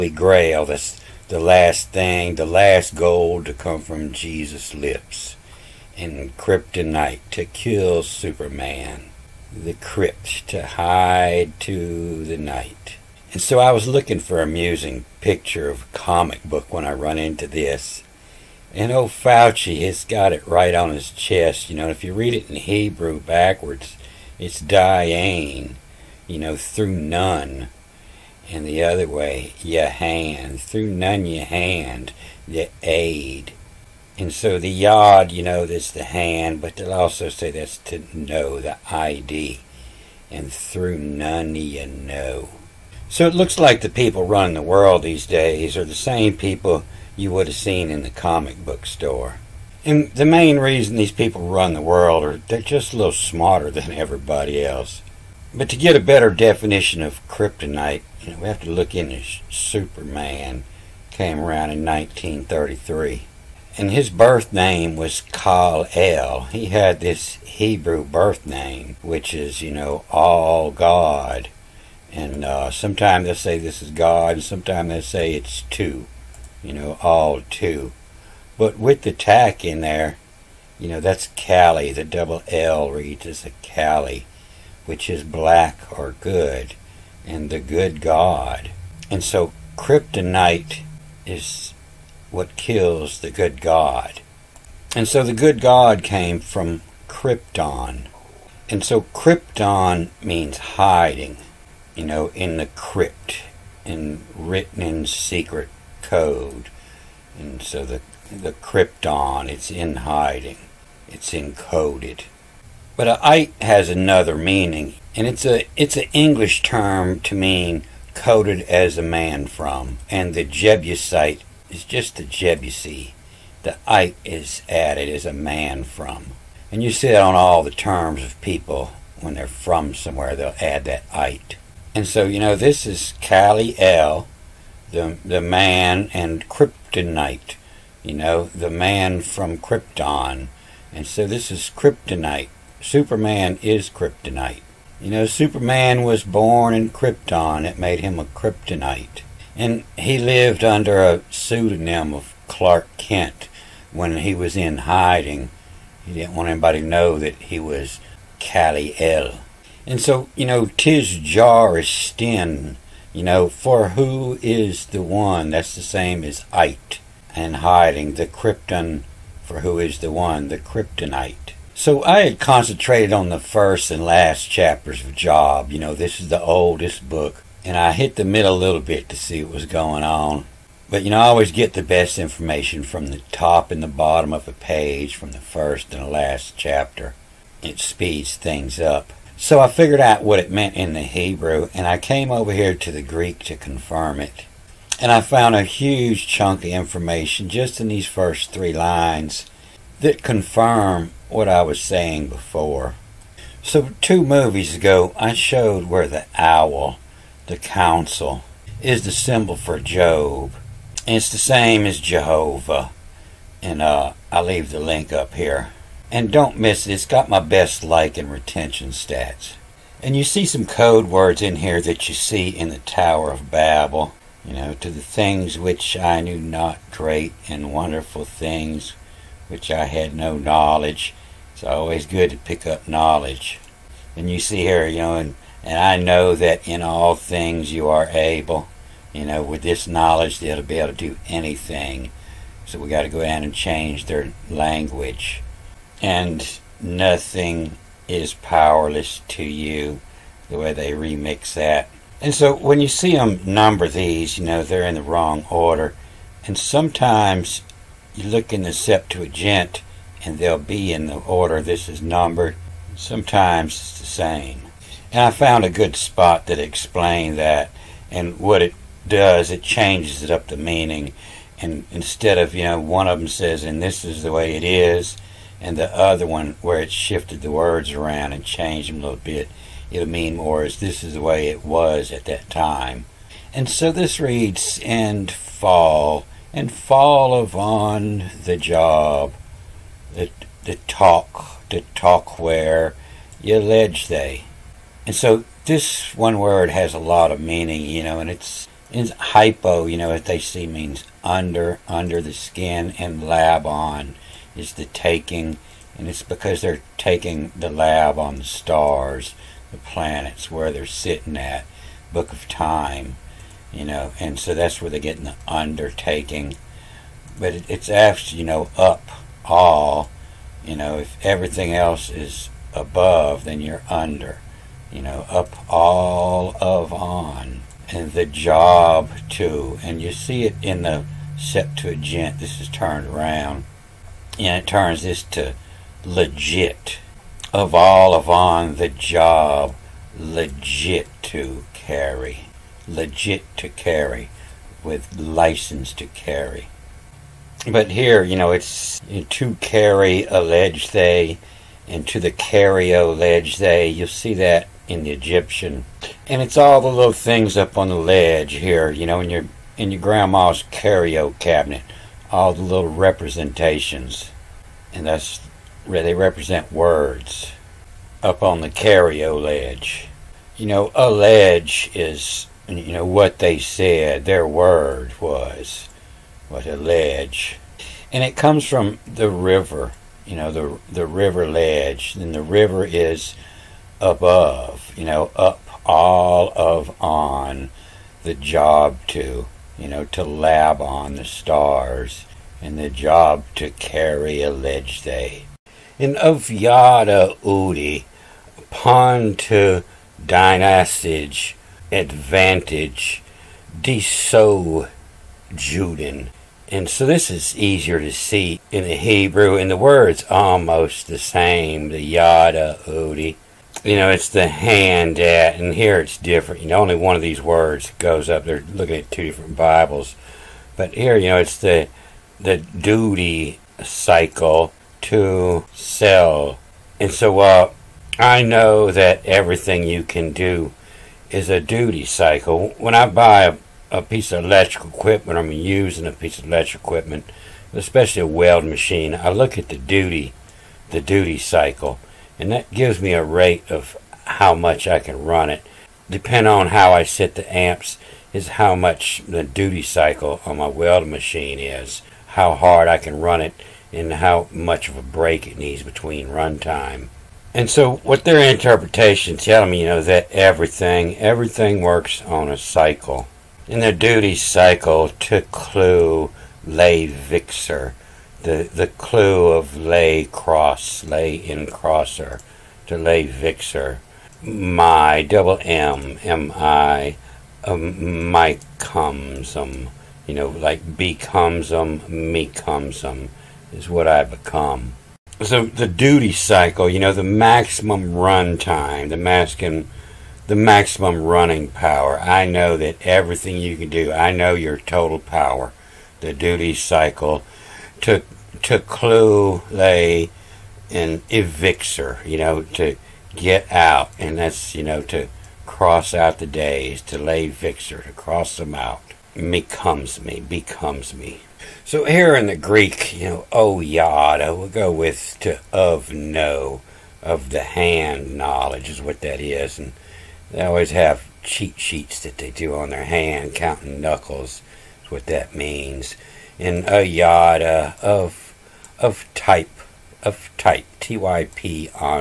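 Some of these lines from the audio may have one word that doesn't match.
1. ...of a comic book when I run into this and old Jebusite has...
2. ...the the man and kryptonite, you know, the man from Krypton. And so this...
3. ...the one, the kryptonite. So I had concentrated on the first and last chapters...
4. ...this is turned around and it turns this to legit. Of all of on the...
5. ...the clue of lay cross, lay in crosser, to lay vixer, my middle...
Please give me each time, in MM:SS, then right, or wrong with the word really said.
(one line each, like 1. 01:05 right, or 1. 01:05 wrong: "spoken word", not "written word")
1. 00:15 wrong: "Fauci", not "Jebusite"
2. 02:14 right
3. 02:49 right
4. 05:32 right
5. 07:48 wrong: "double", not "middle".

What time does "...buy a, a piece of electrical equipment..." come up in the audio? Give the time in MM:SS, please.
07:13.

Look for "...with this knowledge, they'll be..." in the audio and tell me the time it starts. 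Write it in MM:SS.
03:59.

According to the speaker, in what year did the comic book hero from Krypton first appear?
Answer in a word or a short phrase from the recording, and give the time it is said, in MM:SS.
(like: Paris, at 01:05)
1933, at 01:01.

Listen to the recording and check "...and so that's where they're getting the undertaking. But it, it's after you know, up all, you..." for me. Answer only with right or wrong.
right.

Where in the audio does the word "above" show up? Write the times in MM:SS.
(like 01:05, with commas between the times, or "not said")
05:22, 06:24.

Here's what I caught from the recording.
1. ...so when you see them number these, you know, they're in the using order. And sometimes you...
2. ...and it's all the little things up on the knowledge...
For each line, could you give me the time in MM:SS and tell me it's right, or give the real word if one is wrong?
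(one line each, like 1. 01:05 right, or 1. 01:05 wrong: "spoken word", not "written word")
1. 04:12 wrong: "wrong", not "using"
2. 05:56 wrong: "ledge", not "knowledge".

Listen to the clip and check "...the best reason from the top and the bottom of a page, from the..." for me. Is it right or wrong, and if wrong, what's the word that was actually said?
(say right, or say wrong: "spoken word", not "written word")
wrong: "information", not "reason".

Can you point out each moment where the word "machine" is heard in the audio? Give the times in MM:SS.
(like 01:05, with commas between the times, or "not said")
07:18, 07:31.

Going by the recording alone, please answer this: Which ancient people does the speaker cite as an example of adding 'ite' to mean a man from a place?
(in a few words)
Jebusite.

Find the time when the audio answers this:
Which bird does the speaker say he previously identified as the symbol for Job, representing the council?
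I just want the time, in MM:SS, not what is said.
03:26.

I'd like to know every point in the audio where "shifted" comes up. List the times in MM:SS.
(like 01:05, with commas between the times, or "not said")
04:36.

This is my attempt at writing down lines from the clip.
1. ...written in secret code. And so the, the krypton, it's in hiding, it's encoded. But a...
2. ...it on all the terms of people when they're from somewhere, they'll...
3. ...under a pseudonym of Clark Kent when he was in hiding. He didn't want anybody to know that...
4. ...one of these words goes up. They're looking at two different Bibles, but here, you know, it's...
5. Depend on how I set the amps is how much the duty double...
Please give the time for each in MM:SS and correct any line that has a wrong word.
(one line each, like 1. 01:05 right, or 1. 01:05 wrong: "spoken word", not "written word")
1. 01:44 right
2. 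02:07 right
3. 02:30 right
4. 06:56 right
5. 07:26 wrong: "cycle", not "double".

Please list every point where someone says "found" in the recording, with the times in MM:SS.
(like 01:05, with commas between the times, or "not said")
03:15, 04:25.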